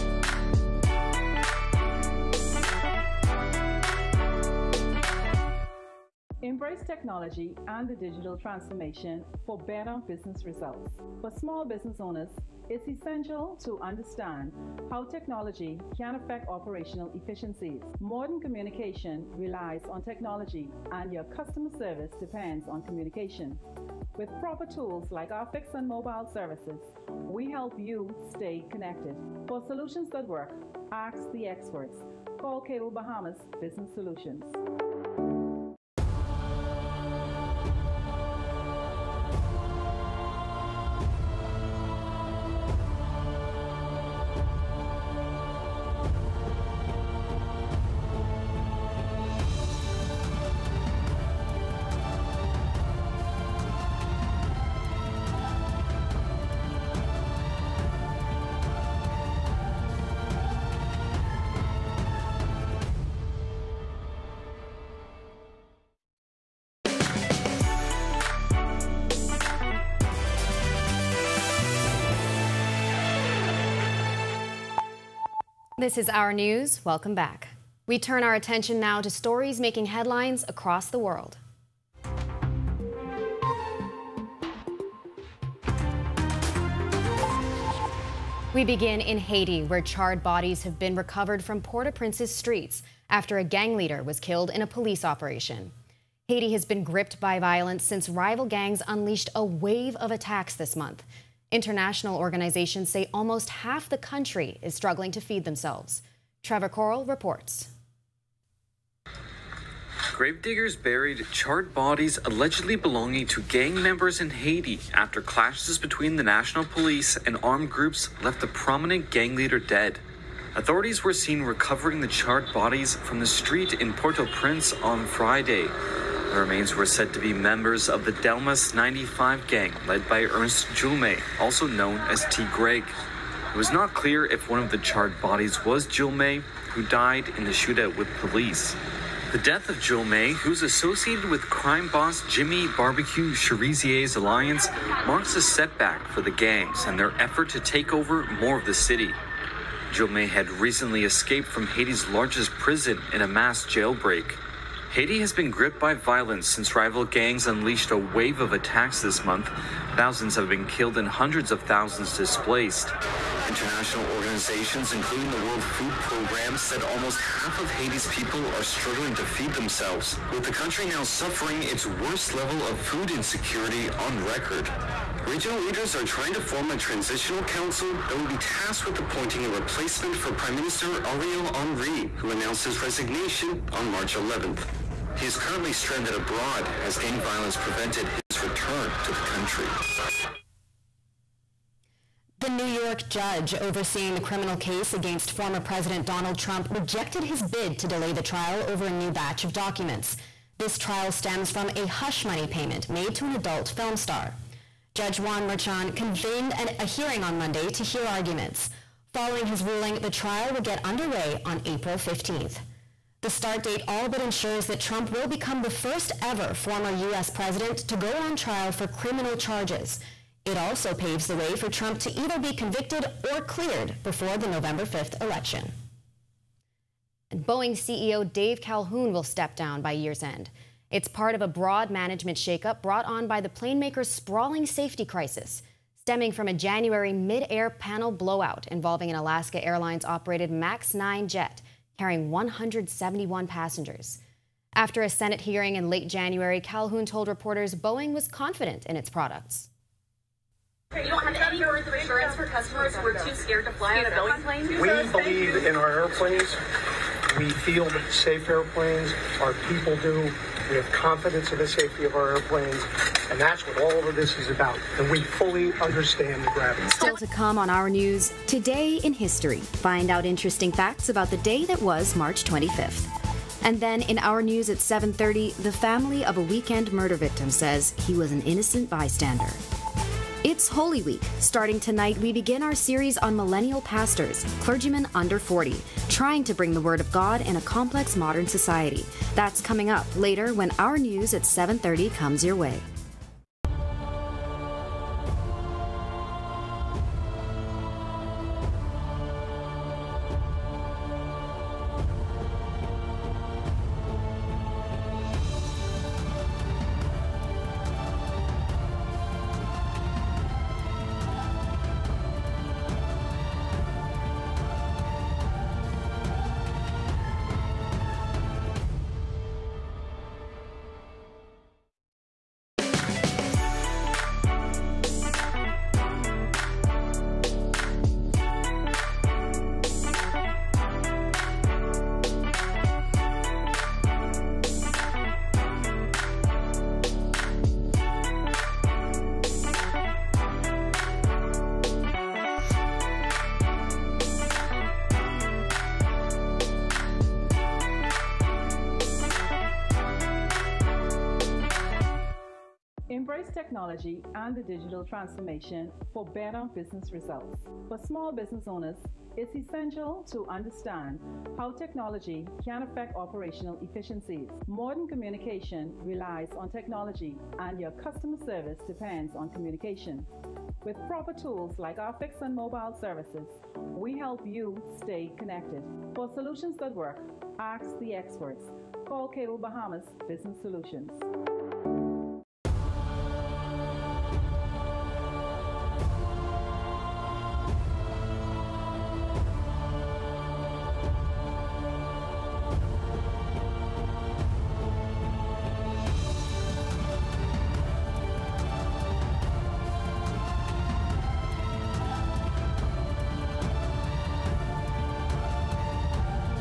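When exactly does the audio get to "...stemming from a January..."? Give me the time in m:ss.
3:55.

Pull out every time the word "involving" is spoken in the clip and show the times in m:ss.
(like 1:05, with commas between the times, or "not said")
3:58.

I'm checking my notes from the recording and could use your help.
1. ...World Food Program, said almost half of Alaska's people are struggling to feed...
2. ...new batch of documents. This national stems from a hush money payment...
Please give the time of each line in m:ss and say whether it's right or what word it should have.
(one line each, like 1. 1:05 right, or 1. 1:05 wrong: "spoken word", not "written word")
1. 2:45 wrong: "Haiti", not "Alaska"
2. 3:18 wrong: "trial", not "national".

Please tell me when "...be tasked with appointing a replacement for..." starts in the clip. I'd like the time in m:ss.
2:58.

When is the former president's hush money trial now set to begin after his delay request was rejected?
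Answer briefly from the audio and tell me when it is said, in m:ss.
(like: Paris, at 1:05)
April 15th, at 3:31.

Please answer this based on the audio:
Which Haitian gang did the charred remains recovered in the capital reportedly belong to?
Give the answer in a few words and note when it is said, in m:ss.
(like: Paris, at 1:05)
Delmas 95, at 2:08.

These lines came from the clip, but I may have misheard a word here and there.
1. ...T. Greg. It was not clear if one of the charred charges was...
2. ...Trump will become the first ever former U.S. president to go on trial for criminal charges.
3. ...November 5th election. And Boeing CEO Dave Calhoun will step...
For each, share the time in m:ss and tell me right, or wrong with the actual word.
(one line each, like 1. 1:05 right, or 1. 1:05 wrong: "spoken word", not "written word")
1. 2:12 wrong: "bodies", not "charges"
2. 3:34 right
3. 3:44 right.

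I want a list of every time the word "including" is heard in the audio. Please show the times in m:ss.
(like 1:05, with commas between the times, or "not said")
2:44.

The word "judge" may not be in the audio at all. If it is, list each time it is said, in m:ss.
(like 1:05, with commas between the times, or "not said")
3:13, 3:24.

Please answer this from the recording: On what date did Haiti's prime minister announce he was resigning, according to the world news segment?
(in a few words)
March 11th.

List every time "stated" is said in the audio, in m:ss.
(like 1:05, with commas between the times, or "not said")
not said.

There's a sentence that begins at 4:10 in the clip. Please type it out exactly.
You don't have any words of assurance for customers who are too scared to fly on a Boeing plane?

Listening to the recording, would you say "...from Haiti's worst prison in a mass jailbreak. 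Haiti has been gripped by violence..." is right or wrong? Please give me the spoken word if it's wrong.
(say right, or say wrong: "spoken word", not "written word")
wrong: "largest", not "worst".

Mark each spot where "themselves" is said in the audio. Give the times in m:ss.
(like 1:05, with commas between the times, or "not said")
1:45, 2:49.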